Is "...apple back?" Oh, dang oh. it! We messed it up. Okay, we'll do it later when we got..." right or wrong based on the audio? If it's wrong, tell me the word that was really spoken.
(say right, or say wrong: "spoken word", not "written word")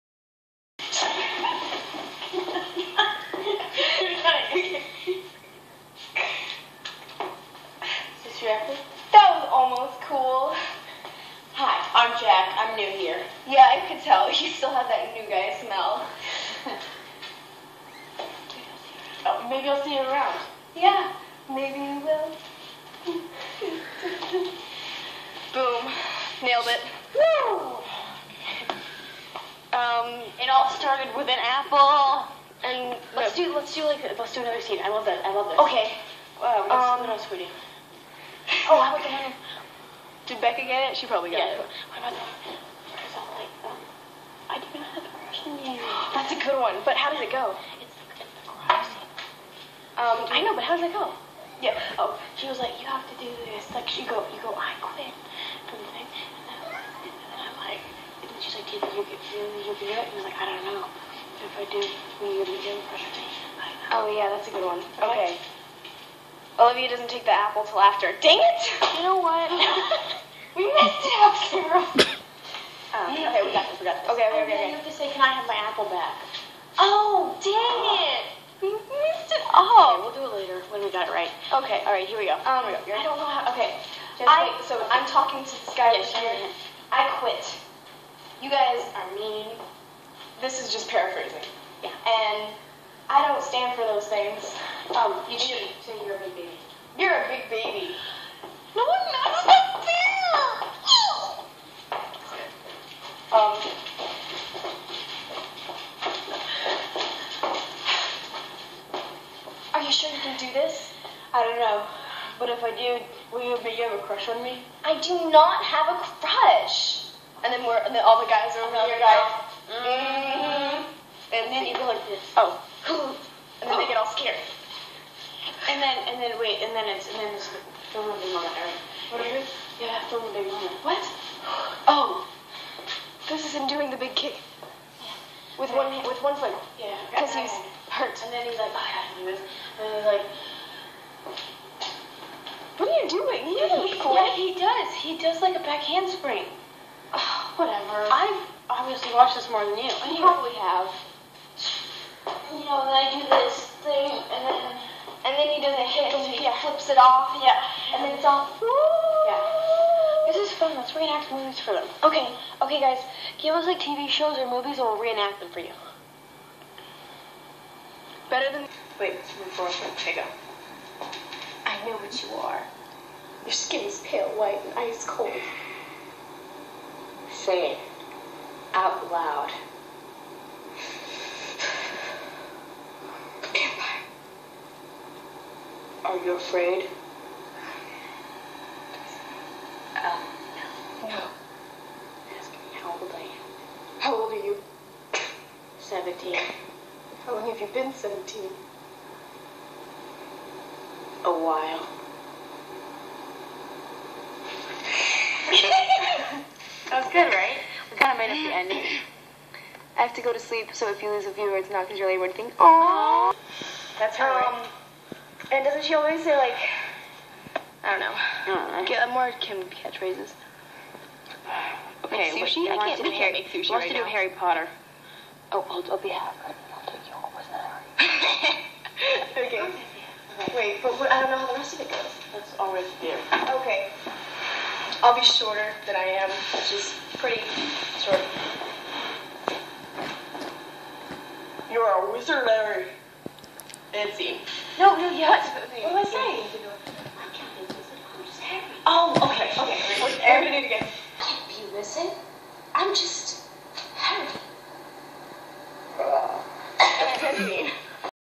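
right.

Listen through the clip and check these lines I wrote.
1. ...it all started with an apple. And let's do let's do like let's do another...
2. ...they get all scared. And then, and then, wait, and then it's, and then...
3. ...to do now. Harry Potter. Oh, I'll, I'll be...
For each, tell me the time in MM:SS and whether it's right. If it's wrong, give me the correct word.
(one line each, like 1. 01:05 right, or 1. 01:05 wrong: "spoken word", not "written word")
1. 00:30 right
2. 02:03 right
3. 03:43 right.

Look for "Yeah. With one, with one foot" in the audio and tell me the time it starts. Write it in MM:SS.
02:15.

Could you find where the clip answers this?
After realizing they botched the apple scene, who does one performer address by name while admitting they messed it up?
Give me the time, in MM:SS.
01:11.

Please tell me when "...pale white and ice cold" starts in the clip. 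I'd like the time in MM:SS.
02:54.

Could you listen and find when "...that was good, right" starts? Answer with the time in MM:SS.
03:26.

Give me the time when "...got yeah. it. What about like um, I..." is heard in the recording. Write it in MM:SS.
00:41.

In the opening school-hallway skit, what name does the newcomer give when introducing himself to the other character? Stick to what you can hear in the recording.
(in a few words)
Jack.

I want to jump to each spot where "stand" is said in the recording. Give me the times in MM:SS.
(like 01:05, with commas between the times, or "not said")
01:33.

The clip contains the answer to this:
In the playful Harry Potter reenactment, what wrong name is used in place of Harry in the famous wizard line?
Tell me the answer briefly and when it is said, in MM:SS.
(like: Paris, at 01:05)
Larry, at 04:02.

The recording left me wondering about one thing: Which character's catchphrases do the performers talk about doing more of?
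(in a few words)
Kim.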